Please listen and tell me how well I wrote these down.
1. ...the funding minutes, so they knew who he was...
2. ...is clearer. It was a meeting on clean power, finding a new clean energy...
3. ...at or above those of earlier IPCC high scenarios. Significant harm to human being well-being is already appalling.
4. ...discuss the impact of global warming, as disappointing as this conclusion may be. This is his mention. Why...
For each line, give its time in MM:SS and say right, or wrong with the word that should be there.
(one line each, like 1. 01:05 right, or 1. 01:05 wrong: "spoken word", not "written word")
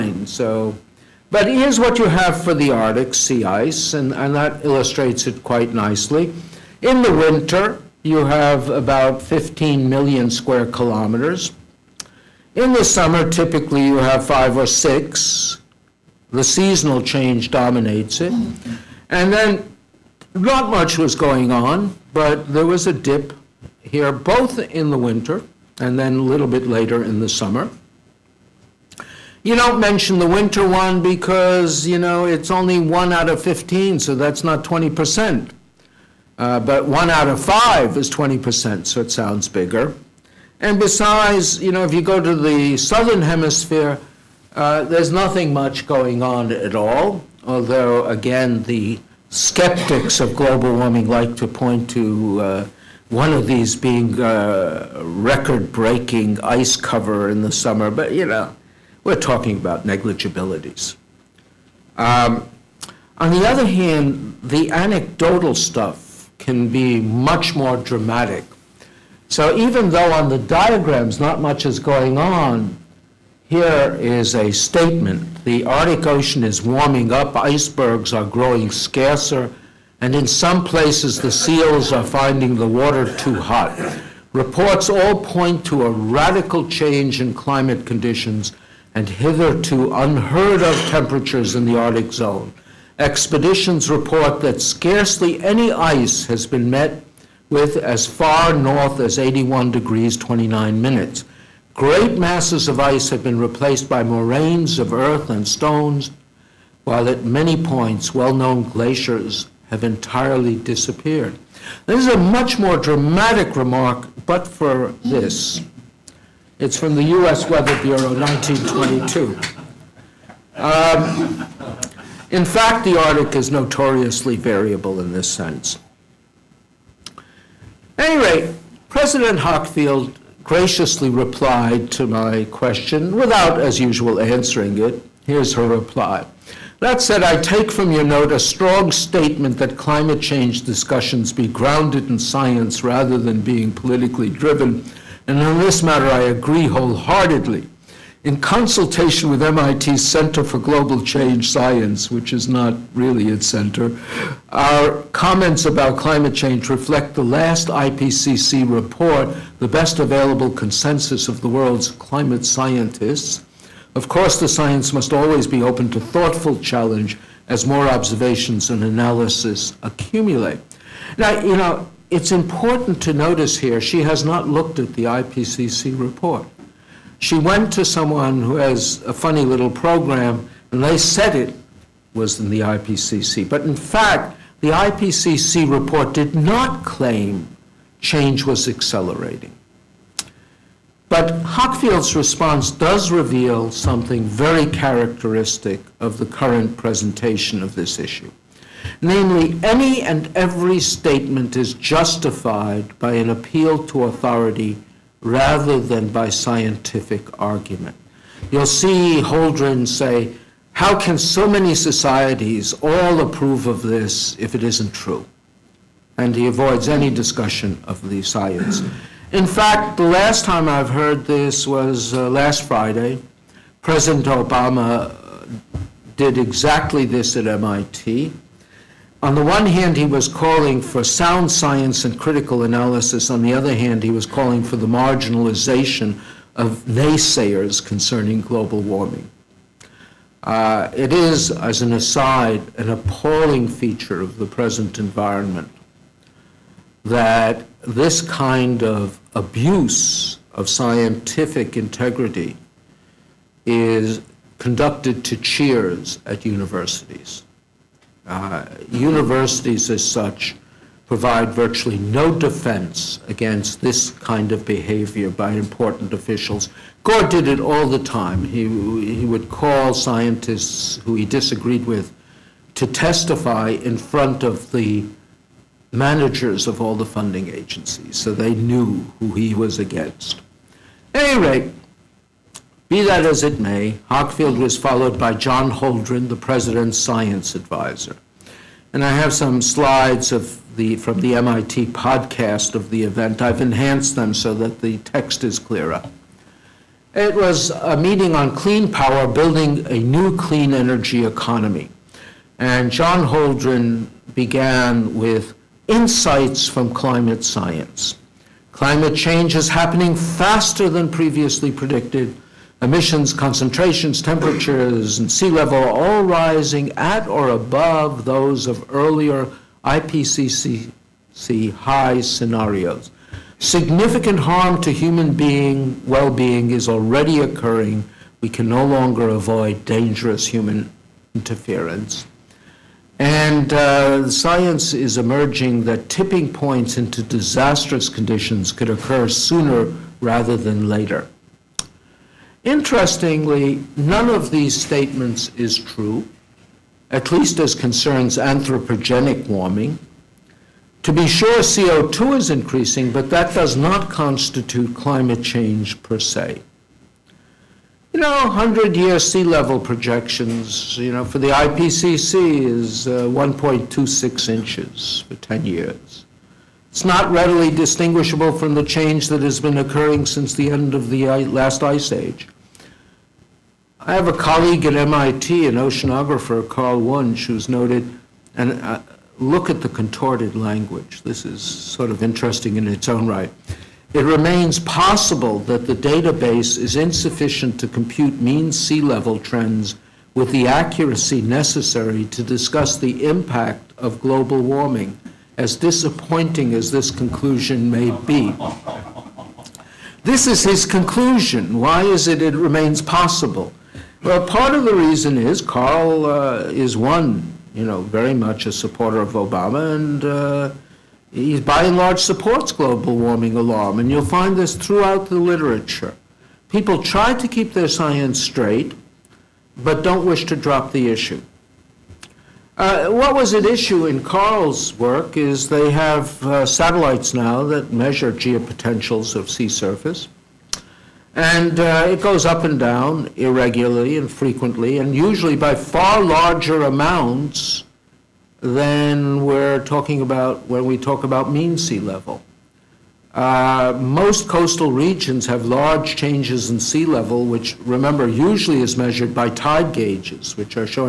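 1. 04:36 wrong: "agencies", not "minutes"
2. 04:55 wrong: "building", not "finding"
3. 05:16 wrong: "occurring", not "appalling"
4. 06:32 wrong: "conclusion", not "mention".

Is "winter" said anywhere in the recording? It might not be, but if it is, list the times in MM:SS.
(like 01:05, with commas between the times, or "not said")
00:07, 00:24, 00:30.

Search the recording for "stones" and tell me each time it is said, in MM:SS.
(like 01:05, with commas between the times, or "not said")
01:45.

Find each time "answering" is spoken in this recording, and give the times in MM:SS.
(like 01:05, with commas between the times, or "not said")
02:14.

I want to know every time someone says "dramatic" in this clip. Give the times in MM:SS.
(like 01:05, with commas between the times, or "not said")
01:07, 01:52.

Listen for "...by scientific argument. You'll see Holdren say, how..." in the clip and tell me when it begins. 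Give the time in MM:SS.
03:26.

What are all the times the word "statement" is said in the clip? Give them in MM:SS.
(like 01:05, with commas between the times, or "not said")
01:14, 02:18, 03:20, 05:44.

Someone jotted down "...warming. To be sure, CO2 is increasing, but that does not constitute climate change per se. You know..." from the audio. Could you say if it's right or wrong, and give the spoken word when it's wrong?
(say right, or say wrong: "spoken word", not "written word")
right.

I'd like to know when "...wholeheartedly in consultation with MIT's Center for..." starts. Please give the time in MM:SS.
02:26.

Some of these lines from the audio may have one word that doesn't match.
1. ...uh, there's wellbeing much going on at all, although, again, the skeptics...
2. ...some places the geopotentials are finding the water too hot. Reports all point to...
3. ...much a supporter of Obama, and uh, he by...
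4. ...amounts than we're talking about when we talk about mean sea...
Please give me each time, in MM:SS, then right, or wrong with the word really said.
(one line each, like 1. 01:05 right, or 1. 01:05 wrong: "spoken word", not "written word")
1. 00:44 wrong: "nothing", not "wellbeing"
2. 01:20 wrong: "seals", not "geopotentials"
3. 06:48 right
4. 07:16 right.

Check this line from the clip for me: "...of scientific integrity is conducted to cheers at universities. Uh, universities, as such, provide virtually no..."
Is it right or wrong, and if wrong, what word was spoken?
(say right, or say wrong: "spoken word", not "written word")
right.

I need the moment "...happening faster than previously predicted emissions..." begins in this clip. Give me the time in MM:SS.
05:09.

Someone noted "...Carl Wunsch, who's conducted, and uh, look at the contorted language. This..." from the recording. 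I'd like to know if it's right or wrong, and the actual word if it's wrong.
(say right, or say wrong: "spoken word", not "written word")
wrong: "noted", not "conducted".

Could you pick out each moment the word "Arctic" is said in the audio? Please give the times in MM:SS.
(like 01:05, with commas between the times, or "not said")
00:02, 01:15, 01:31, 02:02.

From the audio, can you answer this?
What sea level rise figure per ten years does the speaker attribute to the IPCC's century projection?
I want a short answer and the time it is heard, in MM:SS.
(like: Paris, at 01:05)
1.26 inches, at 06:03.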